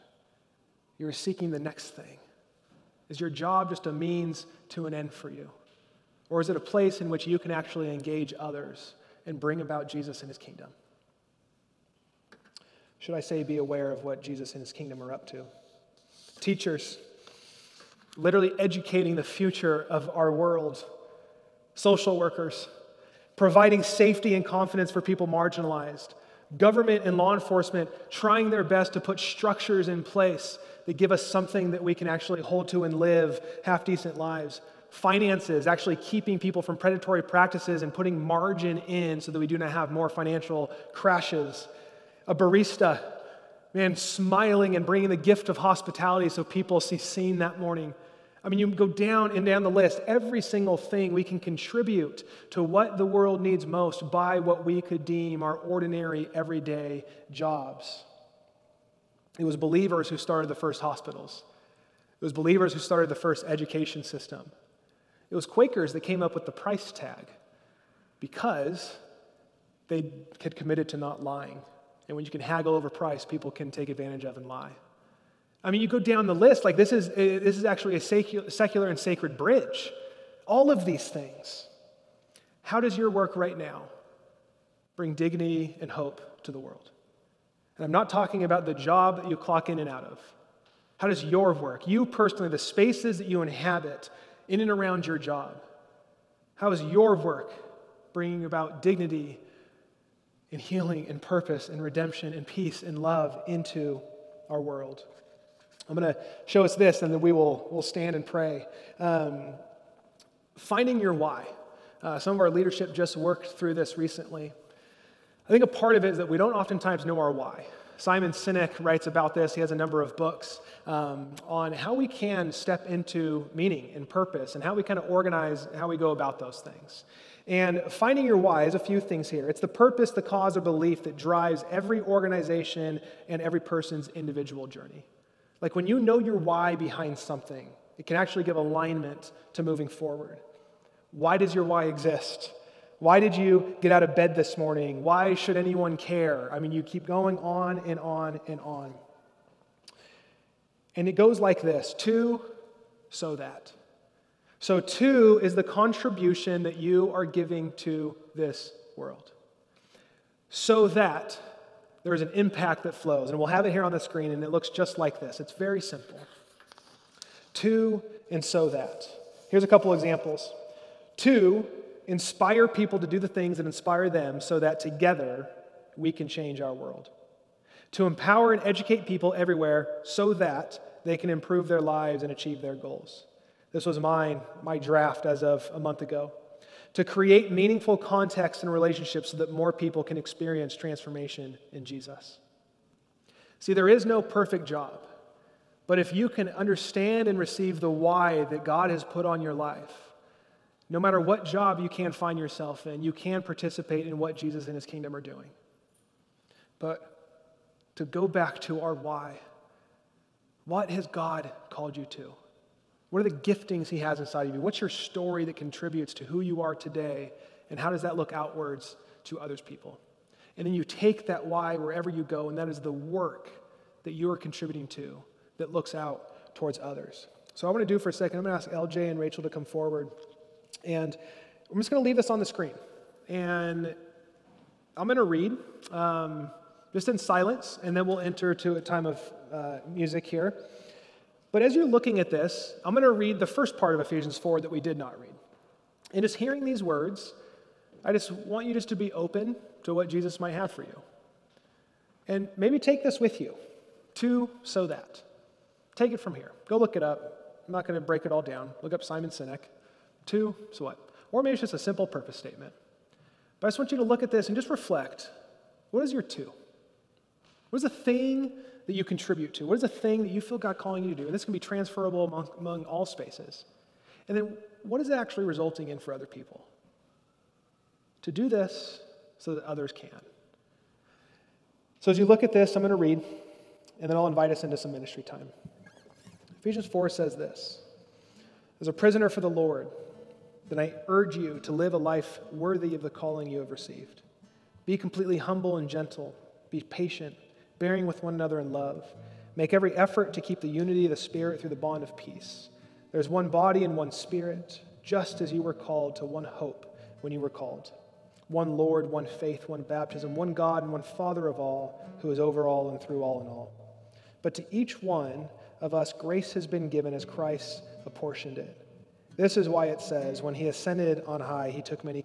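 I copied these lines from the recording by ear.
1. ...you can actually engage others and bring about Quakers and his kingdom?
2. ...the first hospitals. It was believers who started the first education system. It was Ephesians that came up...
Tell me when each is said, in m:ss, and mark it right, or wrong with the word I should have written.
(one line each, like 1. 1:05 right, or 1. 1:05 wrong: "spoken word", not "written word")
1. 0:07 wrong: "Jesus", not "Quakers"
2. 1:00 wrong: "Quakers", not "Ephesians".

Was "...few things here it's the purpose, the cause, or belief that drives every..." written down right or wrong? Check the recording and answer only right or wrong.
right.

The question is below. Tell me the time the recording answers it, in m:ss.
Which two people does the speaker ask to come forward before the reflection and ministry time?
3:48.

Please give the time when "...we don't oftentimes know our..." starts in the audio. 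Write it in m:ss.
1:56.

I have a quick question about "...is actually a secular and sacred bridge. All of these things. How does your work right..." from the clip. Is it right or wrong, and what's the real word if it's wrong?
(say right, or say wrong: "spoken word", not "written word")
right.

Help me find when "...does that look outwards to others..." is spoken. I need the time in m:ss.
3:37.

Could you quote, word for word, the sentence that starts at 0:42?
A barista, man, smiling and bringing the gift of hospitality so people see seen that morning.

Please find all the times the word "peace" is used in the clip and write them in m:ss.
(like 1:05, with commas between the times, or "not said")
1:42, 5:02.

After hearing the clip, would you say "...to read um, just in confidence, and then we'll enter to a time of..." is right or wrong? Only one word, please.
wrong.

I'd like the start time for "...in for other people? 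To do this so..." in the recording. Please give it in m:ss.
4:35.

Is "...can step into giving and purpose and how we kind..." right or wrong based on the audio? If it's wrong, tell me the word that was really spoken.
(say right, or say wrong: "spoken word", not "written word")
wrong: "meaning", not "giving".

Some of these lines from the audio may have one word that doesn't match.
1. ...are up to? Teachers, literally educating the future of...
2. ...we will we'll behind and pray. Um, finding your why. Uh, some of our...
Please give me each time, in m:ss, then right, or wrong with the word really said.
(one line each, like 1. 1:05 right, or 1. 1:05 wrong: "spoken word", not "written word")
1. 0:15 right
2. 1:47 wrong: "stand", not "behind".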